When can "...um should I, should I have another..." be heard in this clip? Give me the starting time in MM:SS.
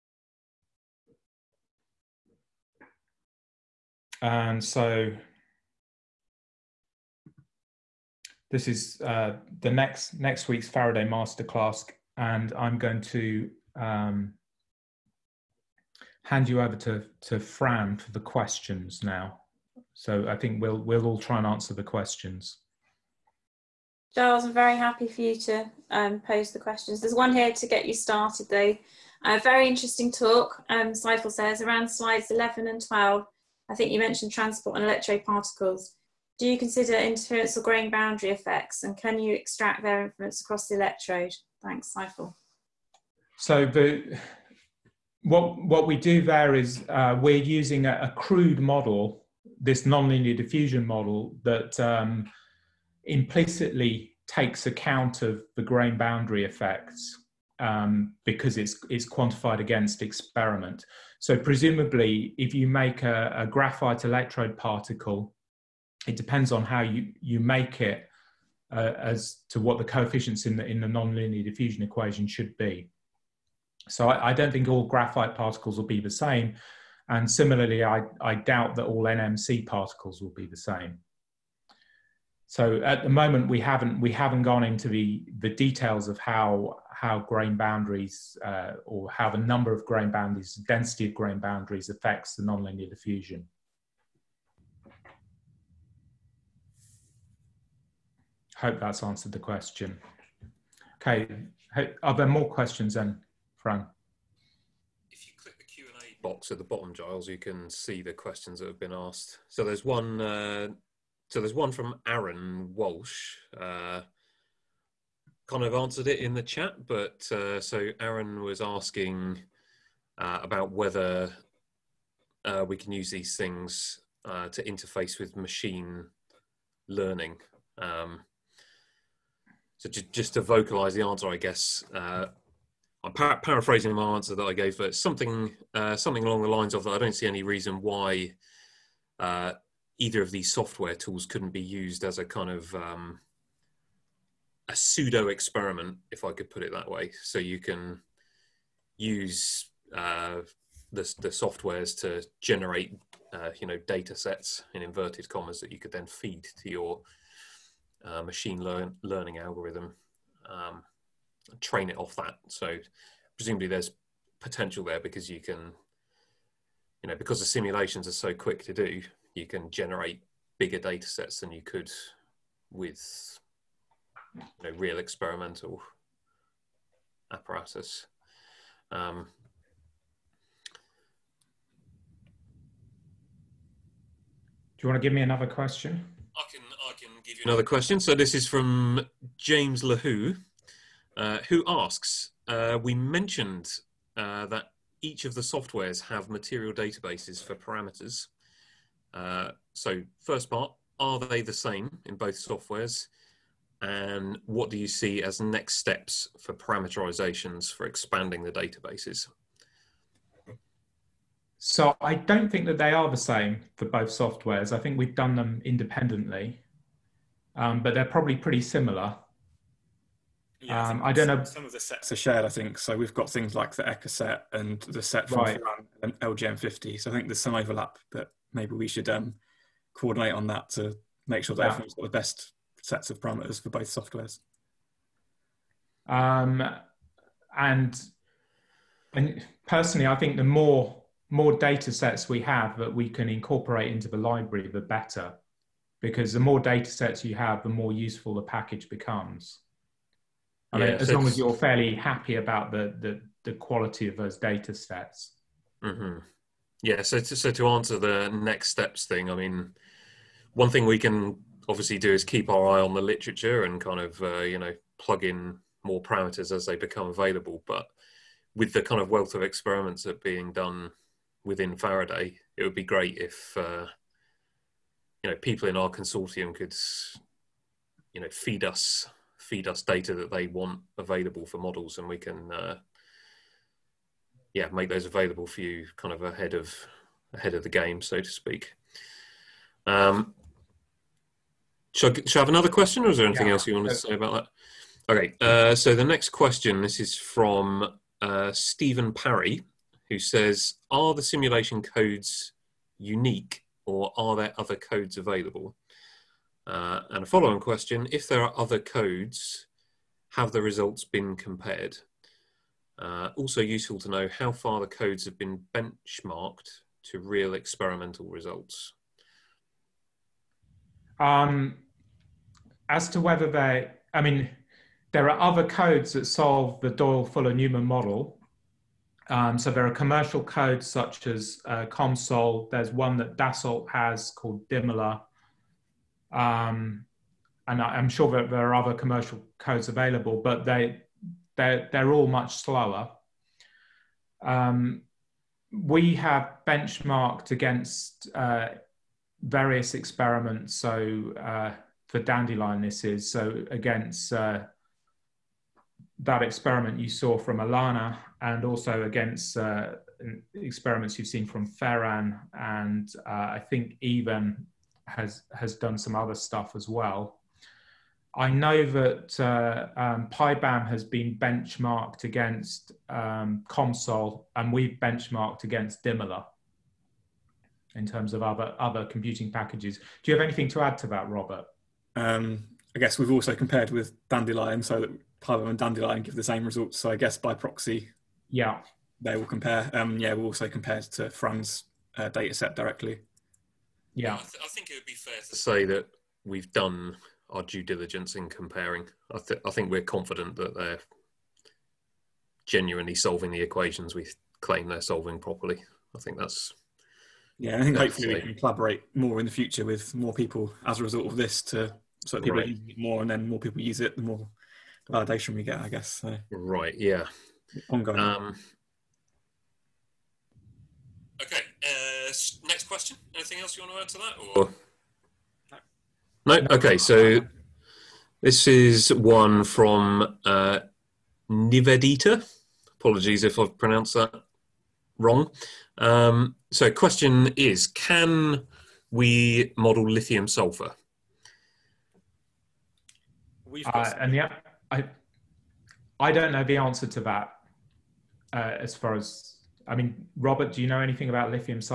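04:49.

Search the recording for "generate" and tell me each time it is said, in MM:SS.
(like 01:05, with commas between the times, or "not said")
02:32, 02:49.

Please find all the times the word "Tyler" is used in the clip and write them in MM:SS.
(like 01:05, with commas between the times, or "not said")
06:25.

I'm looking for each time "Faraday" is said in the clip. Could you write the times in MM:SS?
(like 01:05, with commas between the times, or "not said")
00:10, 04:31.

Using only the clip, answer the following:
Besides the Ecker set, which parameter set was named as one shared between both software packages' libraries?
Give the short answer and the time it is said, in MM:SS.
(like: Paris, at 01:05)
LGM50, at 03:46.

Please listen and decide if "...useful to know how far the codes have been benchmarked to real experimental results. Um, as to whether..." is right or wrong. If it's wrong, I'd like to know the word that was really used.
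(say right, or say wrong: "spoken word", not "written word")
right.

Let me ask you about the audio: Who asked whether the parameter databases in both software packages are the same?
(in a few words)
James Le Houx.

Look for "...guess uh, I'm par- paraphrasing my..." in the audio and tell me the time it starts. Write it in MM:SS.
02:11.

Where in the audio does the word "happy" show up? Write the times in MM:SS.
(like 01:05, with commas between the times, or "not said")
00:24, 04:11.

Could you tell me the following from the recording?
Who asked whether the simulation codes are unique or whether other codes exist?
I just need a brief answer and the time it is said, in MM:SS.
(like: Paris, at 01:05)
Stephen Parry, at 04:58.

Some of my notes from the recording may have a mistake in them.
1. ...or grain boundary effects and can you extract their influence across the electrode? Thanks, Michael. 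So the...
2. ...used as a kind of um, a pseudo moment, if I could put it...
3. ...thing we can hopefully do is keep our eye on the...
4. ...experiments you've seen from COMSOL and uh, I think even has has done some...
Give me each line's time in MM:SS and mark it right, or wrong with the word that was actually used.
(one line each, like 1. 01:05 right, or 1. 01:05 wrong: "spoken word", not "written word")
1. 00:37 right
2. 02:21 wrong: "experiment", not "moment"
3. 04:20 wrong: "obviously", not "hopefully"
4. 06:00 wrong: "Ferran", not "COMSOL".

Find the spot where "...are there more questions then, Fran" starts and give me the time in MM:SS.
01:42.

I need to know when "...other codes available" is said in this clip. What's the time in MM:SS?
05:04.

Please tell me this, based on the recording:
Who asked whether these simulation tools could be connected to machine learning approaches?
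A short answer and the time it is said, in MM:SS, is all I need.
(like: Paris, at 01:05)
Aaron Walsh, at 01:52.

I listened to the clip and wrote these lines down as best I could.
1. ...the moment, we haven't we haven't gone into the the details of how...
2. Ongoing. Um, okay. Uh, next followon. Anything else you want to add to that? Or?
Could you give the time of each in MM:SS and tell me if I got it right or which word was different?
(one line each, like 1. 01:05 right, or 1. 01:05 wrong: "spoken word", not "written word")
1. 01:23 right
2. 06:57 wrong: "question", not "followon".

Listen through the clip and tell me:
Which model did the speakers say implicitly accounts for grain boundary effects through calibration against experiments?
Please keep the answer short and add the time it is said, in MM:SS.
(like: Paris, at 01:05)
Nonlinear diffusion model, at 00:49.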